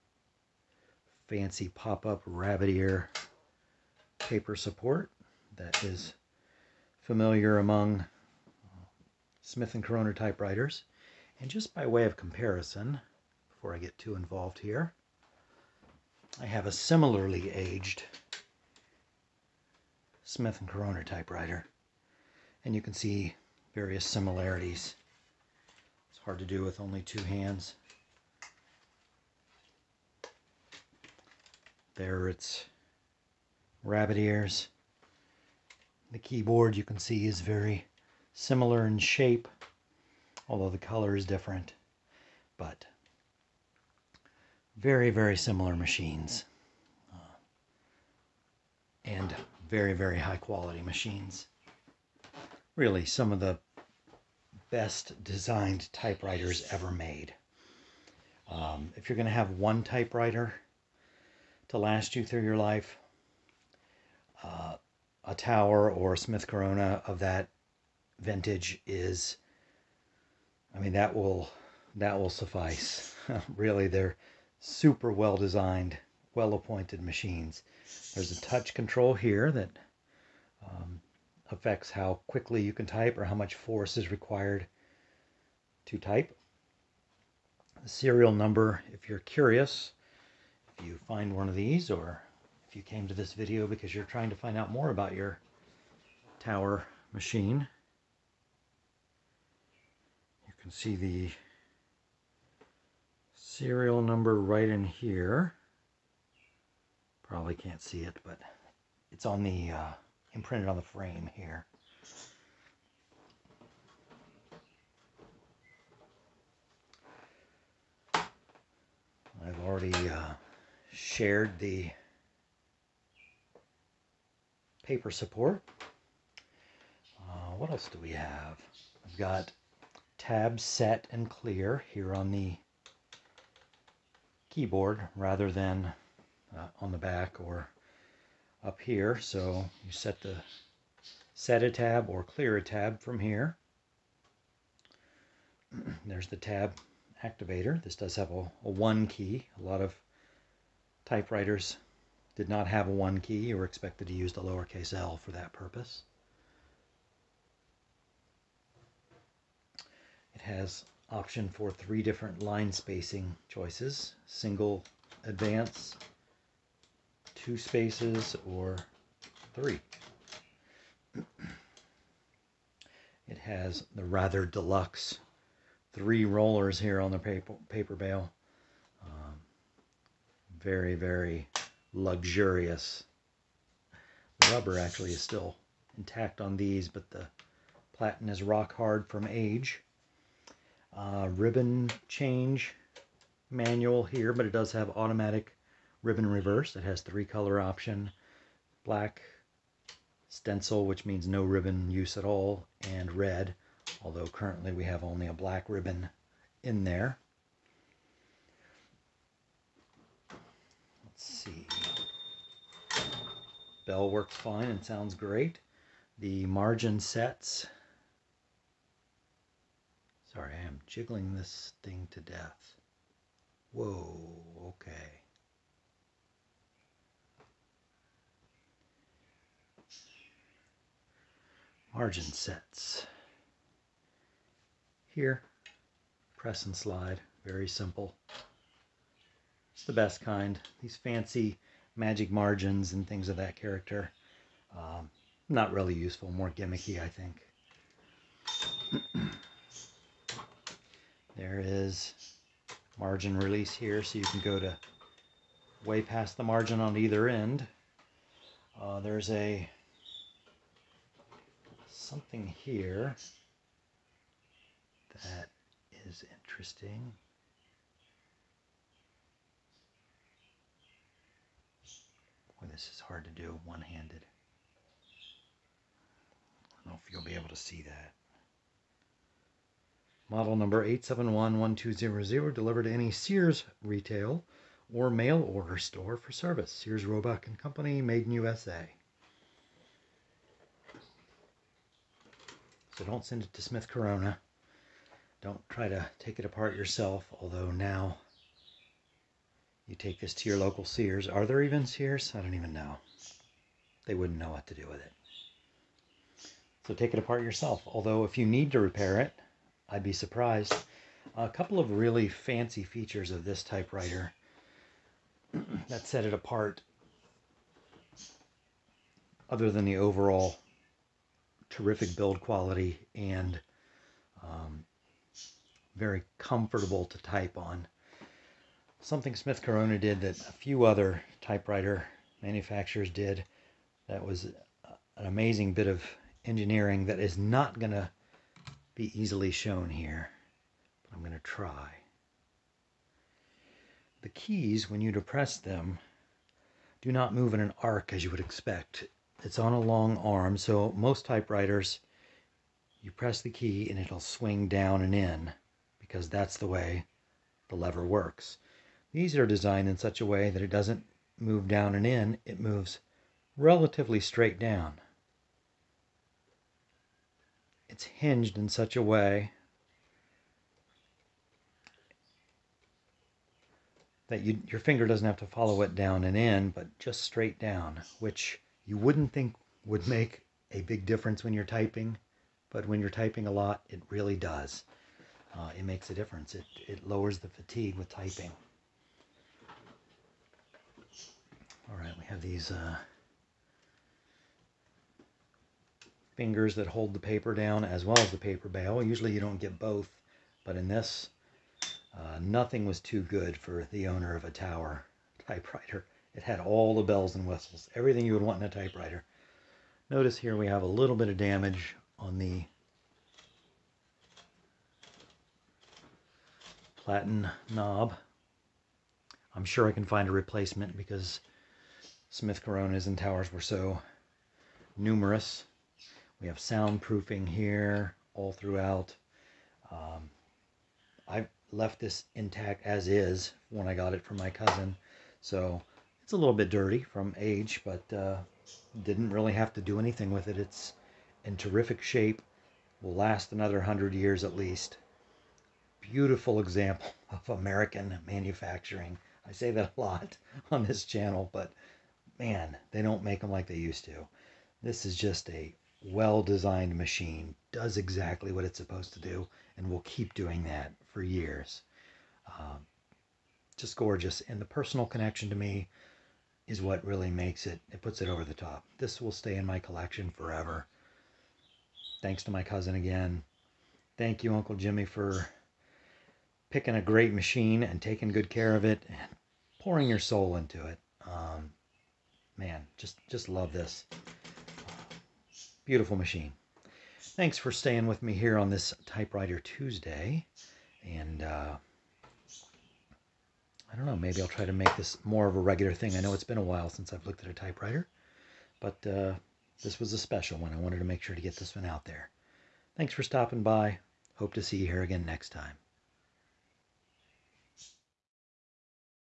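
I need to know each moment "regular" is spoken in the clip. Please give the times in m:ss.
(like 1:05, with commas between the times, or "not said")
8:15.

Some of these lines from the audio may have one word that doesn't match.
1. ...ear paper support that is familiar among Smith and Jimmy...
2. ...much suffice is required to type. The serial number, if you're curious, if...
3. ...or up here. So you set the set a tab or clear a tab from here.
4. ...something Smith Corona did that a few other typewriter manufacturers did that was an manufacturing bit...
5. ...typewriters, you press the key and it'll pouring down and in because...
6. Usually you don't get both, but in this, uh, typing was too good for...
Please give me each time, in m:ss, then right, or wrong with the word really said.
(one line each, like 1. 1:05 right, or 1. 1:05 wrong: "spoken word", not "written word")
1. 0:02 wrong: "Corona", not "Jimmy"
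2. 1:23 wrong: "force", not "suffice"
3. 2:17 right
4. 5:29 wrong: "amazing", not "manufacturing"
5. 5:51 wrong: "swing", not "pouring"
6. 6:39 wrong: "nothing", not "typing".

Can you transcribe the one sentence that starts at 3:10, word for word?
Uh, ribbon change manual here, but it does have automatic ribbon reverse.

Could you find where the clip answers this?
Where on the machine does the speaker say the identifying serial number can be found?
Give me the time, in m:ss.
1:50.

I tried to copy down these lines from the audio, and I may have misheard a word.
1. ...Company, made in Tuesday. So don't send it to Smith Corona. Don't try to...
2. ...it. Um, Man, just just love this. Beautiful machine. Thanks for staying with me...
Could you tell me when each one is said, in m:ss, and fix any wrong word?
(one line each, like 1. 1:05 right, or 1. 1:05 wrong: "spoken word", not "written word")
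1. 4:47 wrong: "USA", not "Tuesday"
2. 8:00 right.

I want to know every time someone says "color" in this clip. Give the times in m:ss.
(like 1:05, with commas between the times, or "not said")
0:40, 3:17.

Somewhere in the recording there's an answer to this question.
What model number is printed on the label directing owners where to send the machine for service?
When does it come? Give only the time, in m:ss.
4:40.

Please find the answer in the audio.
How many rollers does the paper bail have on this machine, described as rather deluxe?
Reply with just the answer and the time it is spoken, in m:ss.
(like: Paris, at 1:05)
3, at 2:55.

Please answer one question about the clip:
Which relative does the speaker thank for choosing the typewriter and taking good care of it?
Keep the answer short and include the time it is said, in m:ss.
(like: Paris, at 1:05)
Uncle Jimmy, at 7:54.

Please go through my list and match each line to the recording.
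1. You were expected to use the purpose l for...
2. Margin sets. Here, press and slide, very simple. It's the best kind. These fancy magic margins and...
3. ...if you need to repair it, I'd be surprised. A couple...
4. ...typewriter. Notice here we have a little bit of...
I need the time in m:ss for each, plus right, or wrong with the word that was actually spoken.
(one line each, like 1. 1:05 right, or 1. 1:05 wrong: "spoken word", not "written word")
1. 2:33 wrong: "lowercase", not "purpose"
2. 3:51 right
3. 5:08 right
4. 6:48 right.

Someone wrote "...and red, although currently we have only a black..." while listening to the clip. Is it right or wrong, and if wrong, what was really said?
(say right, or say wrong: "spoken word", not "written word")
right.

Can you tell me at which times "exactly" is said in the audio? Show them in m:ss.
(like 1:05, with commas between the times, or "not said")
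7:37.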